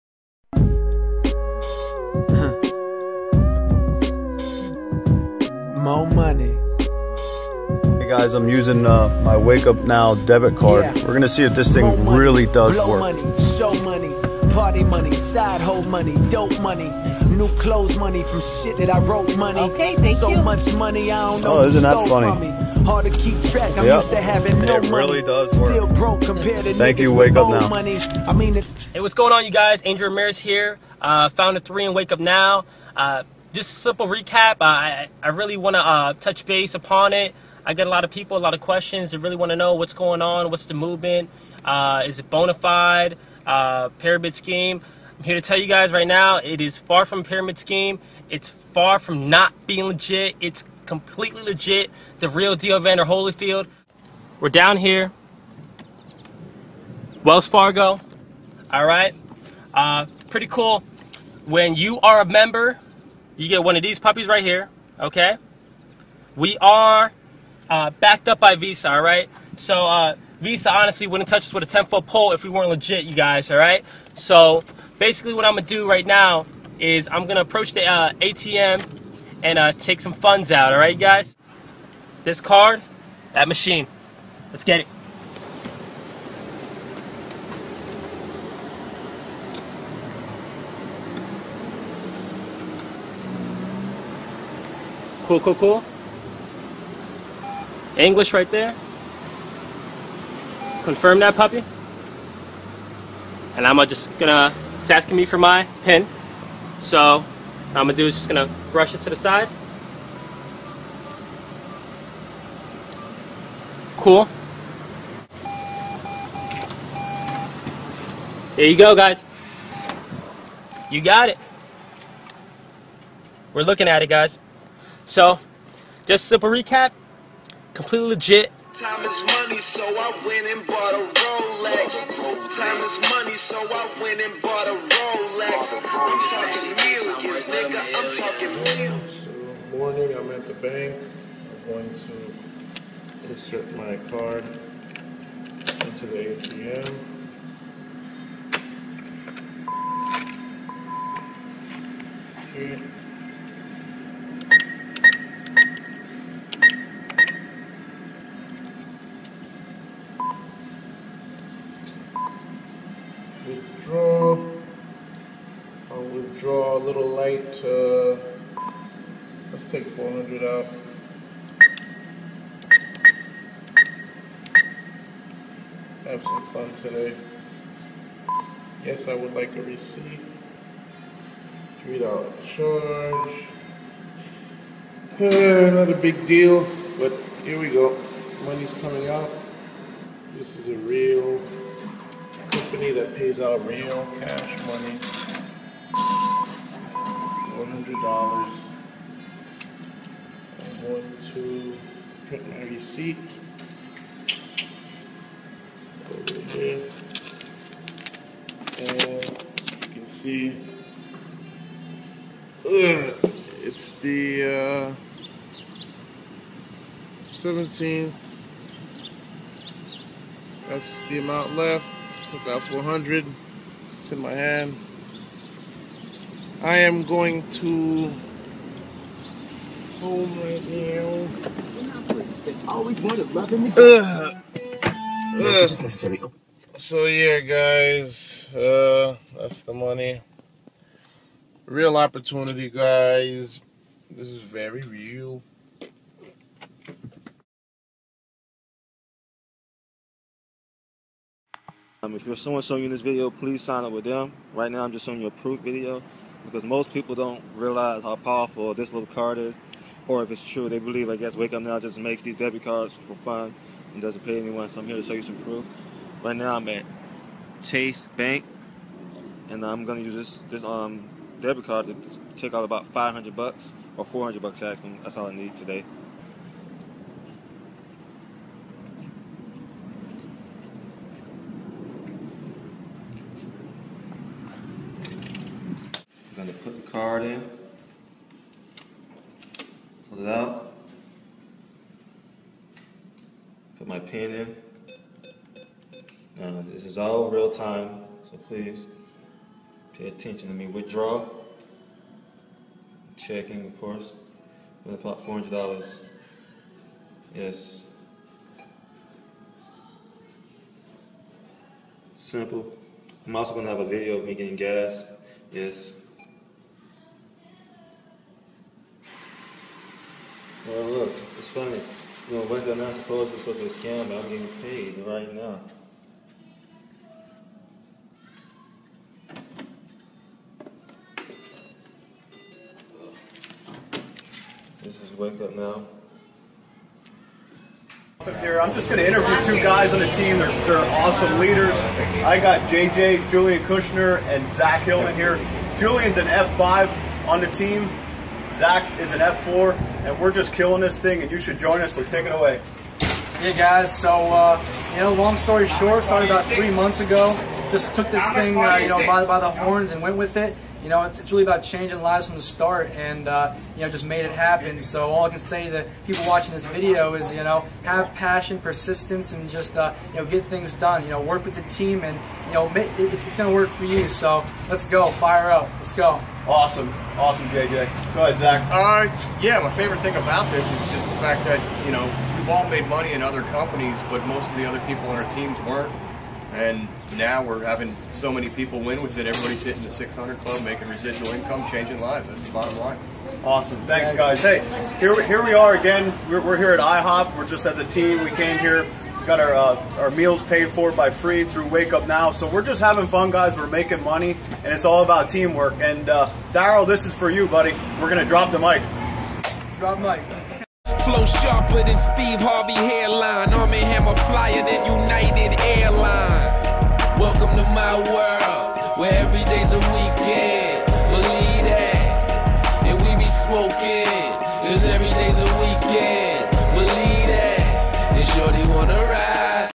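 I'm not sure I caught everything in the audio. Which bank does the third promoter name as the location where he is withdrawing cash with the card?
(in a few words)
Chase Bank.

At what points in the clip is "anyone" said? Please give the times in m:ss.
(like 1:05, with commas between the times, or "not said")
4:24.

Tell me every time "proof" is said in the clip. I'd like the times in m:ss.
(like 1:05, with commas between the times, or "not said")
4:15, 4:25.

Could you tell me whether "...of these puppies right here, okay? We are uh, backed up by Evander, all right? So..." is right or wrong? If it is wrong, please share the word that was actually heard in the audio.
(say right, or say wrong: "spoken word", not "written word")
wrong: "Visa", not "Evander".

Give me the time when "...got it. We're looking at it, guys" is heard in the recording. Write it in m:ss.
2:00.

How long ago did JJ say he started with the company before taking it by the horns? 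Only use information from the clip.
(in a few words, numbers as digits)
3 months.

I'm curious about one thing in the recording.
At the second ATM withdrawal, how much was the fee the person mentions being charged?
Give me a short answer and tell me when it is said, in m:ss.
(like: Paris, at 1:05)
$3, at 3:01.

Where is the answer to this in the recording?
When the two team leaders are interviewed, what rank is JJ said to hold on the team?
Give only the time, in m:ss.
5:46.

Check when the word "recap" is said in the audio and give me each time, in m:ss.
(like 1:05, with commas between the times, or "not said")
0:34, 2:06.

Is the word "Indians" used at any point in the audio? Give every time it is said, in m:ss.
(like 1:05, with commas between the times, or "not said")
not said.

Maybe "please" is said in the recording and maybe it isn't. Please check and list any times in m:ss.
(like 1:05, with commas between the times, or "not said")
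4:13, 4:58.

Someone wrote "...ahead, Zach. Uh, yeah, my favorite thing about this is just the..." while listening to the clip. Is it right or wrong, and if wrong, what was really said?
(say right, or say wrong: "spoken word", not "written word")
right.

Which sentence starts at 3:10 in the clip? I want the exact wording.
This is a real company that pays out real cash money.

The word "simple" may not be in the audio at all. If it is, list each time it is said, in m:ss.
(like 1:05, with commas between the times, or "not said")
0:33, 2:06, 5:12.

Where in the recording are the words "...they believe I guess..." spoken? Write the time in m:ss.
4:20.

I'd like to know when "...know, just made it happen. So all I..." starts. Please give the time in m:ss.
6:03.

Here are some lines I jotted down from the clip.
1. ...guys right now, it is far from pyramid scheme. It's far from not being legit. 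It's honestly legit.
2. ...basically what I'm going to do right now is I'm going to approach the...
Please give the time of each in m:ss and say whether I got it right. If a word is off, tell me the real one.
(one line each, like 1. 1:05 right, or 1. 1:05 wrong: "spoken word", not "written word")
1. 0:45 wrong: "completely", not "honestly"
2. 1:14 right.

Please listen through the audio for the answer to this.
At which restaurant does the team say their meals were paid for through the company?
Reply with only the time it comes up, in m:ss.
6:36.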